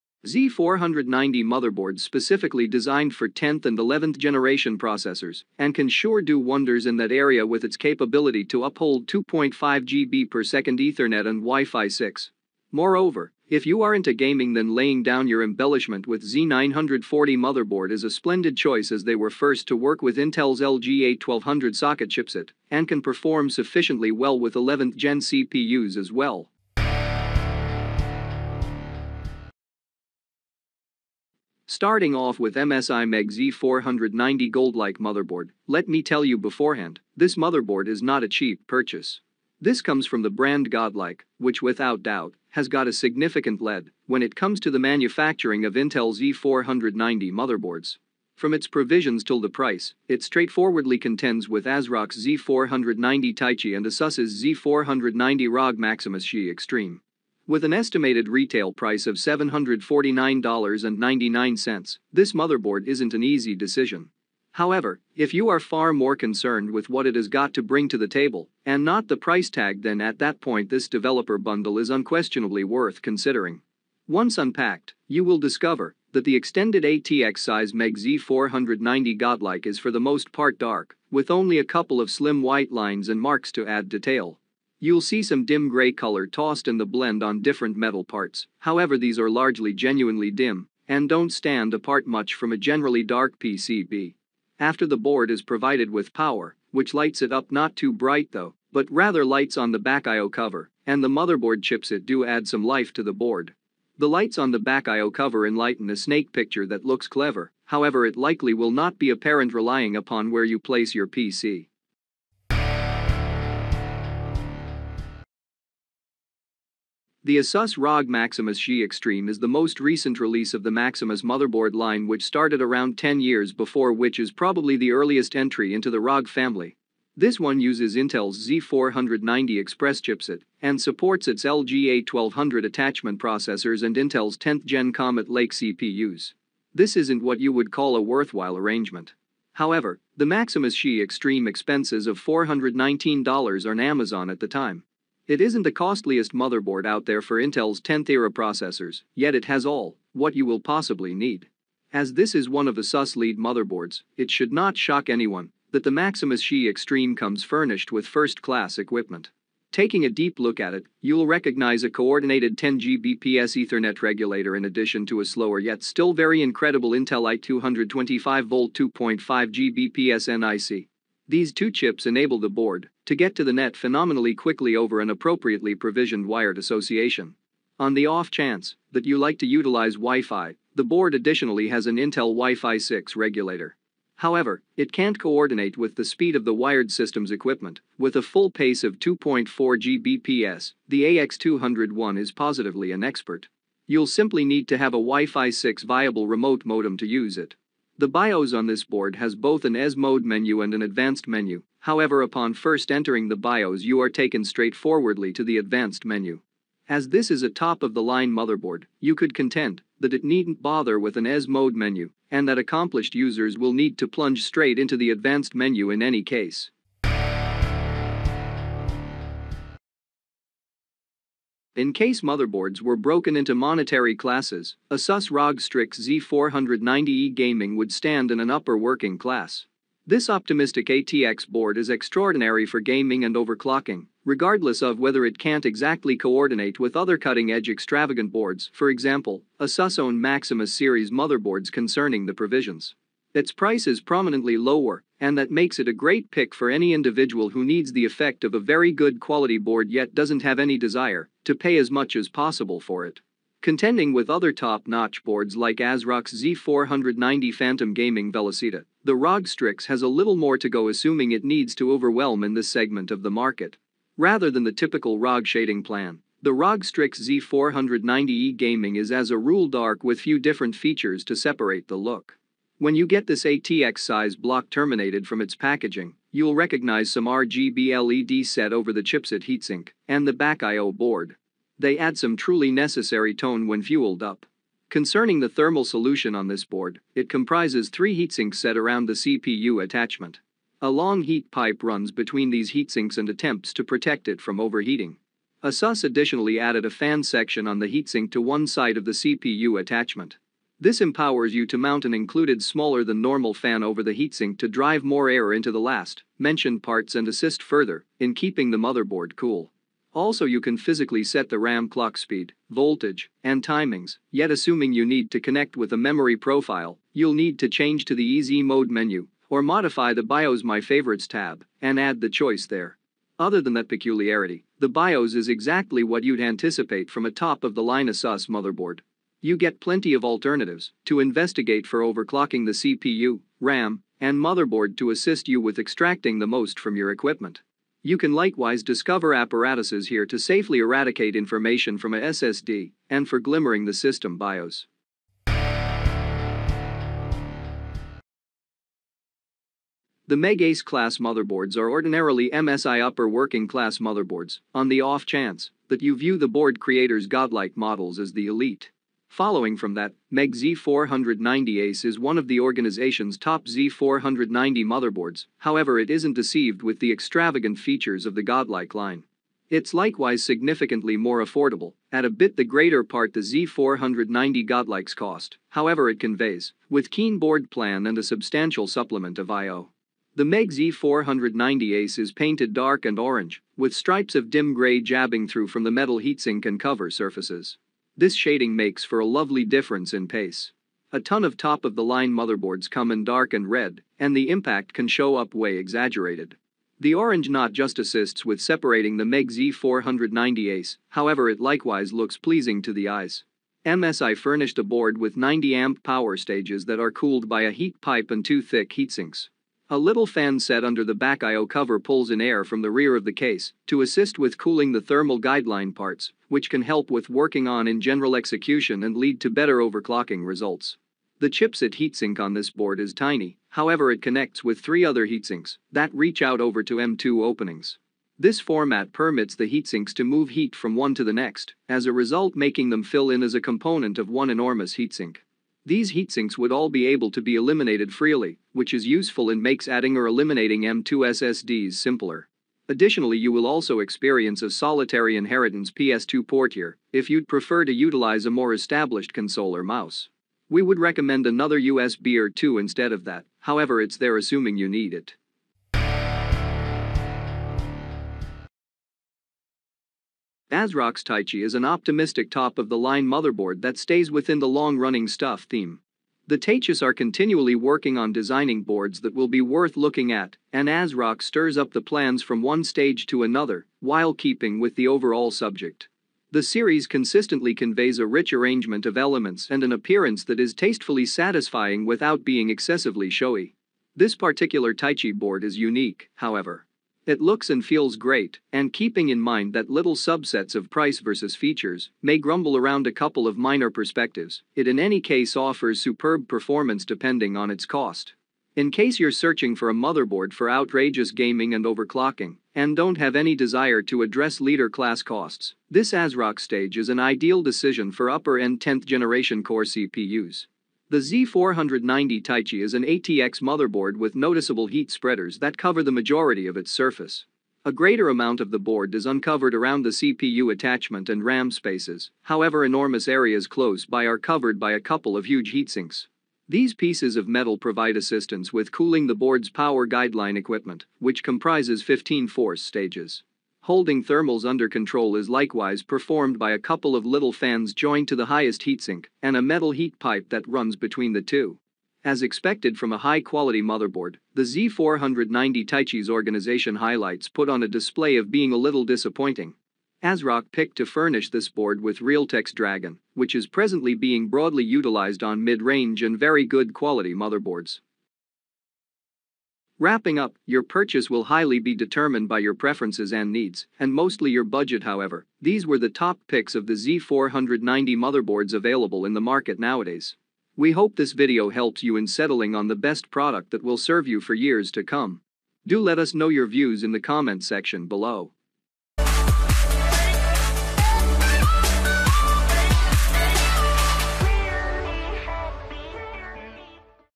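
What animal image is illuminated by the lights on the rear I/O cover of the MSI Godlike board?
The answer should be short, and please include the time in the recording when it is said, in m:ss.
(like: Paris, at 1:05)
snake, at 1:45.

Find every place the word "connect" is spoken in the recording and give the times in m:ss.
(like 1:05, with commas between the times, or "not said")
5:15, 7:04.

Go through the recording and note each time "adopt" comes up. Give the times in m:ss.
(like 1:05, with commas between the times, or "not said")
not said.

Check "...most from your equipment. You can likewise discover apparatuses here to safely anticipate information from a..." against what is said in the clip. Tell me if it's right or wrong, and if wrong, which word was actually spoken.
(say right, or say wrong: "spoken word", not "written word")
wrong: "eradicate", not "anticipate".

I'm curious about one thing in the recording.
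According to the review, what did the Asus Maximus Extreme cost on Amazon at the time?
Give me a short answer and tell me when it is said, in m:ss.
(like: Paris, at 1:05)
$419, at 2:22.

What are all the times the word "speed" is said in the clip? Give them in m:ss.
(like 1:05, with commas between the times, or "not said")
3:06, 5:12.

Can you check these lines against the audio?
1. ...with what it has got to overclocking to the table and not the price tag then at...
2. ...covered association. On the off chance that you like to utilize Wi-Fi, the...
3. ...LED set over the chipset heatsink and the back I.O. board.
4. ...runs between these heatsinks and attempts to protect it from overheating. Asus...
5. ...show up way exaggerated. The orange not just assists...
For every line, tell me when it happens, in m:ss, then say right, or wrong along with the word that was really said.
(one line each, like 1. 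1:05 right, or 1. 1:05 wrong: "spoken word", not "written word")
1. 1:06 wrong: "bring", not "overclocking"
2. 2:56 wrong: "wired", not "covered"
3. 4:37 right
4. 4:51 right
5. 6:35 right.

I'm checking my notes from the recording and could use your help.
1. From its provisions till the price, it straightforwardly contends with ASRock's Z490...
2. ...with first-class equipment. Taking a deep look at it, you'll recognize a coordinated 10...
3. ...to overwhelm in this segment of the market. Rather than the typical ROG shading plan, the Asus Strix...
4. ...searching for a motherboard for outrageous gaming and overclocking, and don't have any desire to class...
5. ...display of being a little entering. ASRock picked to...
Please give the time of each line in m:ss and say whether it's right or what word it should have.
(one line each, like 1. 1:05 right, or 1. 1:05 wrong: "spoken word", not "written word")
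1. 0:48 right
2. 2:37 right
3. 4:21 wrong: "ROG", not "Asus"
4. 8:19 wrong: "address", not "class"
5. 9:07 wrong: "disappointing", not "entering".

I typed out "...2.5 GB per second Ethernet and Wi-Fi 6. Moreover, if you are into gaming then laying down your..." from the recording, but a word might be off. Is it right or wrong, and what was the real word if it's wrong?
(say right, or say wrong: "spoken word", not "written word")
right.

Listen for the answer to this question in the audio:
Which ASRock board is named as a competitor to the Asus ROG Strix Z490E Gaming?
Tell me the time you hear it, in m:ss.
4:16.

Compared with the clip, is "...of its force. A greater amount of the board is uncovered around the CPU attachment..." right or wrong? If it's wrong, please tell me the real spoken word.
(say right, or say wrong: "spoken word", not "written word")
wrong: "surface", not "force".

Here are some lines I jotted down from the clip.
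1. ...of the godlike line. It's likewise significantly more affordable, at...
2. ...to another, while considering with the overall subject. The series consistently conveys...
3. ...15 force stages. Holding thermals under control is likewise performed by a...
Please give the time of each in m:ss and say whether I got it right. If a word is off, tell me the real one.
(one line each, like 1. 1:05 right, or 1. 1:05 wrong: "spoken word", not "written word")
1. 6:08 right
2. 7:53 wrong: "keeping", not "considering"
3. 8:52 right.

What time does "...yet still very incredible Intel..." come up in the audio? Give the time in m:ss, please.
2:45.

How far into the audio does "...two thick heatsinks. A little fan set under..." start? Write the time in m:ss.
6:48.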